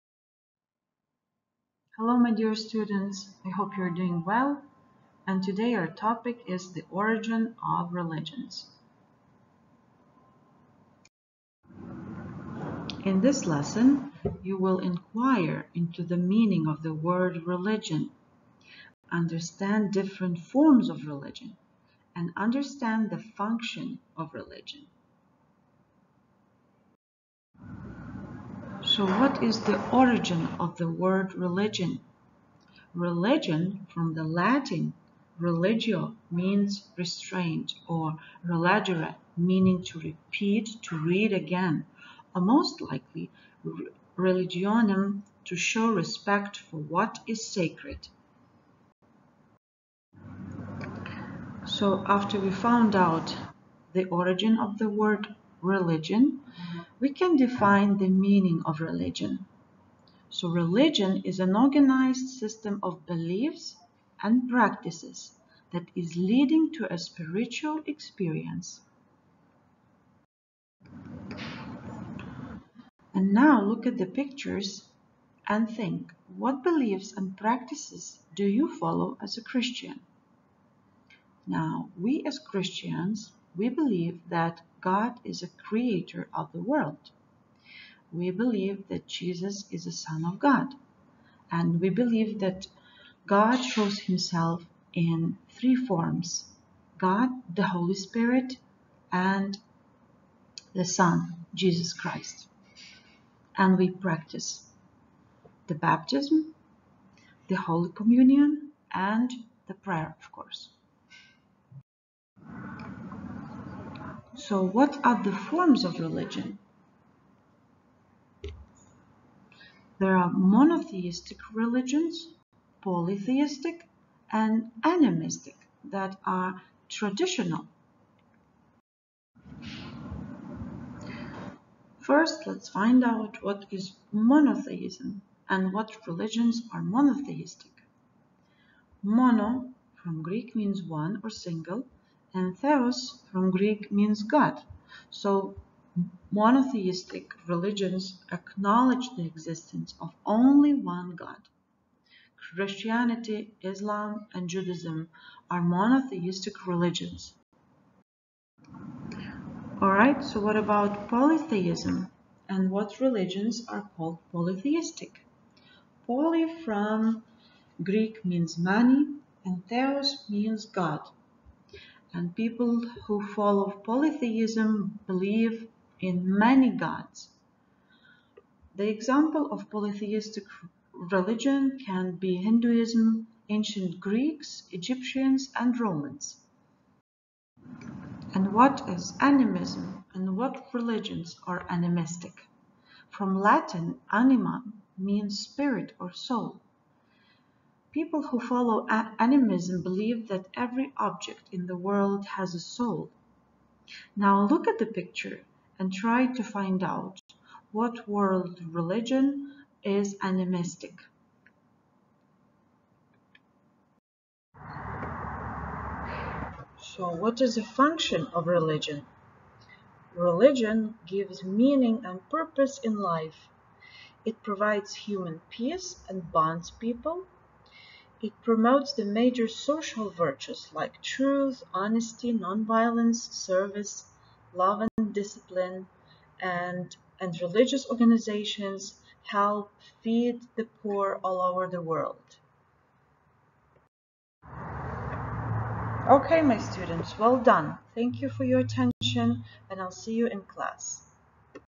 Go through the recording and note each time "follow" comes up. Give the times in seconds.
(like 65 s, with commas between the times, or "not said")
78 s, 173 s, 198 s.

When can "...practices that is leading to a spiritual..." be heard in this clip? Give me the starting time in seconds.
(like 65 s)
64 s.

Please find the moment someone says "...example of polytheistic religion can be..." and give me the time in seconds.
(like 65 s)
178 s.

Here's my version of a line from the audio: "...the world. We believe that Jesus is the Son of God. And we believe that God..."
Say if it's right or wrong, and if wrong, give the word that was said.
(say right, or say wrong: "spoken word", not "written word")
right.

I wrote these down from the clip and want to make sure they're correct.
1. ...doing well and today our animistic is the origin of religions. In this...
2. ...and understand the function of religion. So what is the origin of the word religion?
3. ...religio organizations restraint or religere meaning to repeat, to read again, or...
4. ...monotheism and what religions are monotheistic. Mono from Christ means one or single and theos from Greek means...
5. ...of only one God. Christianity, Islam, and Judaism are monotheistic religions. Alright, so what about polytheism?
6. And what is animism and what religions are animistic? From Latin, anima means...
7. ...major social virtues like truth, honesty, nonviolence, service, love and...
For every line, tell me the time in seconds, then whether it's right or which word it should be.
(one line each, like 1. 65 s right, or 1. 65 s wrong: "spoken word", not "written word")
1. 4 s wrong: "topic", not "animistic"
2. 22 s right
3. 35 s wrong: "means", not "organizations"
4. 134 s wrong: "Greek", not "Christ"
5. 149 s right
6. 188 s right
7. 229 s right.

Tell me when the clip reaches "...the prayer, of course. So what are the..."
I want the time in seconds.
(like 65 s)
109 s.